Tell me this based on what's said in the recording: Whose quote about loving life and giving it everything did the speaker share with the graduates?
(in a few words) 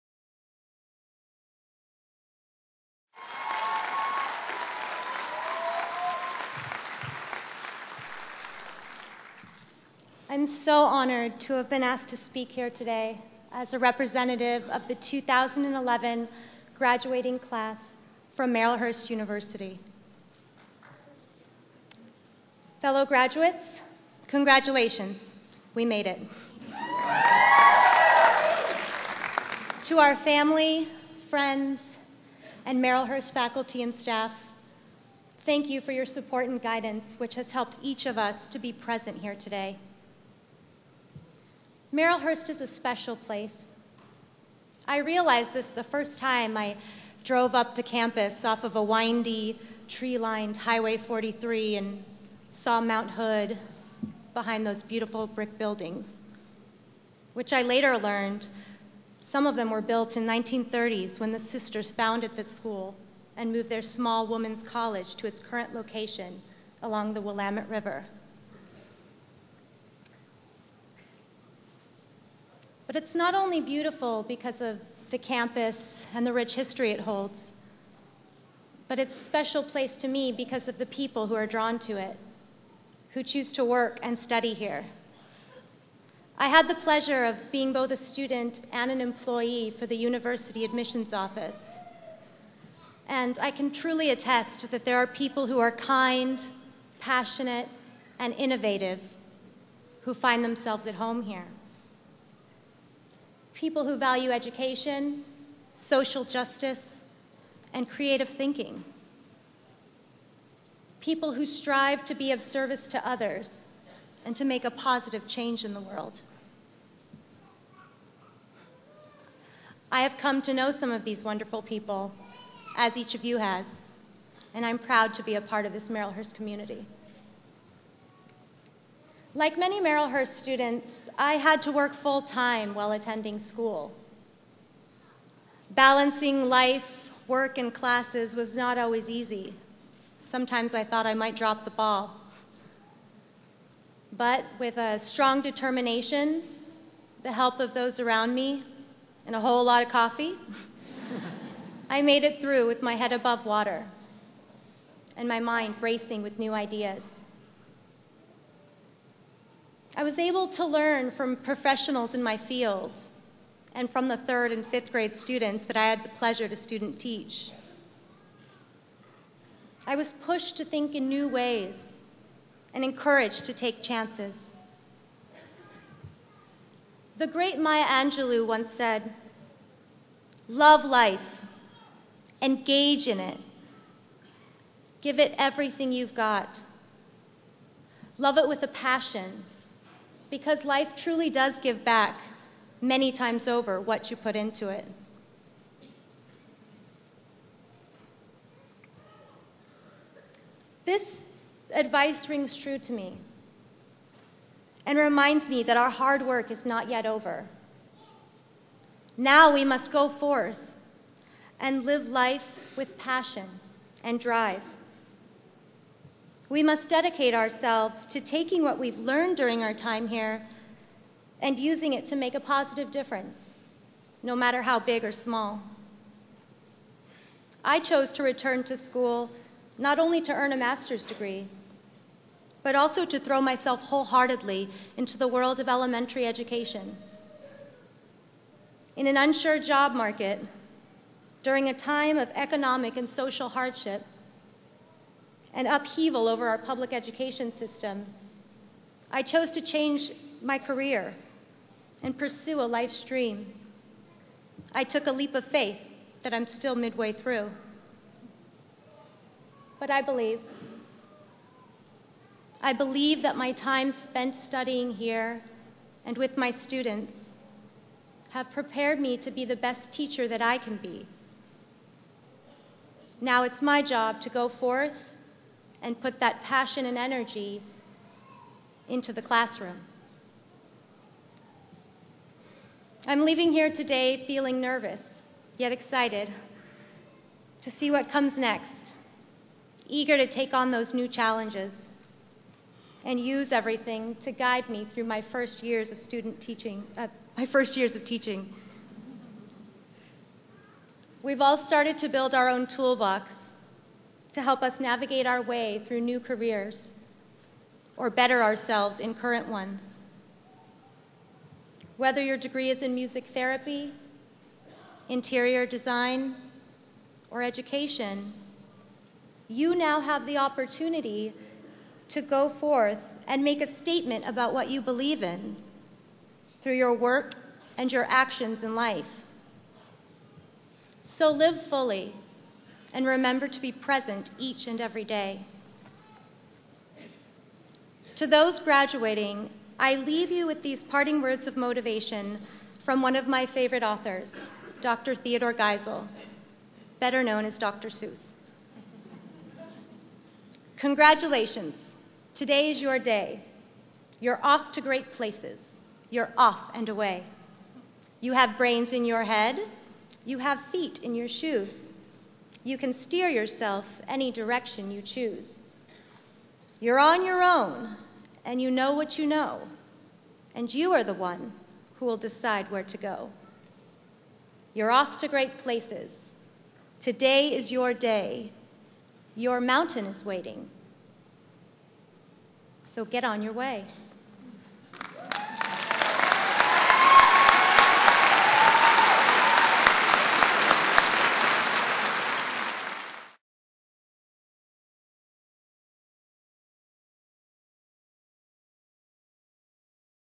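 Maya Angelou.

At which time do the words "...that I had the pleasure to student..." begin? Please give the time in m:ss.
2:45.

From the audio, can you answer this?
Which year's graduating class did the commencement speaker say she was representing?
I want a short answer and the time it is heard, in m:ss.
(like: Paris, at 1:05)
2011, at 0:14.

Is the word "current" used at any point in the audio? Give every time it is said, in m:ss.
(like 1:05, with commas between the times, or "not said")
1:05, 5:09.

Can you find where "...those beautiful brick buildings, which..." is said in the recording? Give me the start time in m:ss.
0:54.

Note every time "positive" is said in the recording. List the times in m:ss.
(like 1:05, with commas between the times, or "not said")
1:54, 3:42.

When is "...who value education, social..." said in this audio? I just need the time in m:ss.
1:43.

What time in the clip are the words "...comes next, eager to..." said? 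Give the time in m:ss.
4:48.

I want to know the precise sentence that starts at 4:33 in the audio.
Now it's my job to go forth and put that passion and energy into the classroom.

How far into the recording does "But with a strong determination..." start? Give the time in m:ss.
2:24.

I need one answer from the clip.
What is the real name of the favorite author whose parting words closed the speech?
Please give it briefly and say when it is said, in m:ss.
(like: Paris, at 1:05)
Theodore Geisel, at 5:45.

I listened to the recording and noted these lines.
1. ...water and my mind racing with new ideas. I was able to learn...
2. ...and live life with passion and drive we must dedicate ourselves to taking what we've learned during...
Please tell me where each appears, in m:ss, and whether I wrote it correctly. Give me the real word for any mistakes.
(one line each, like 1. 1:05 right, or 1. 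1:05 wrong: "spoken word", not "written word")
1. 2:33 right
2. 3:31 right.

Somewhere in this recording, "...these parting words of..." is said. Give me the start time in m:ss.
5:40.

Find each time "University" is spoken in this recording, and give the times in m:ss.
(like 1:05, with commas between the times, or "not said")
0:19, 1:29.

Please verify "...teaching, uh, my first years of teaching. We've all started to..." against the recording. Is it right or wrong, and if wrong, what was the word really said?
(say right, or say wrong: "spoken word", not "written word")
right.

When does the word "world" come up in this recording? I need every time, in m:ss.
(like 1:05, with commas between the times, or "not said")
1:55, 3:55.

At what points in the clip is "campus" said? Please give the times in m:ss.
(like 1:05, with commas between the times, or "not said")
0:47, 1:15.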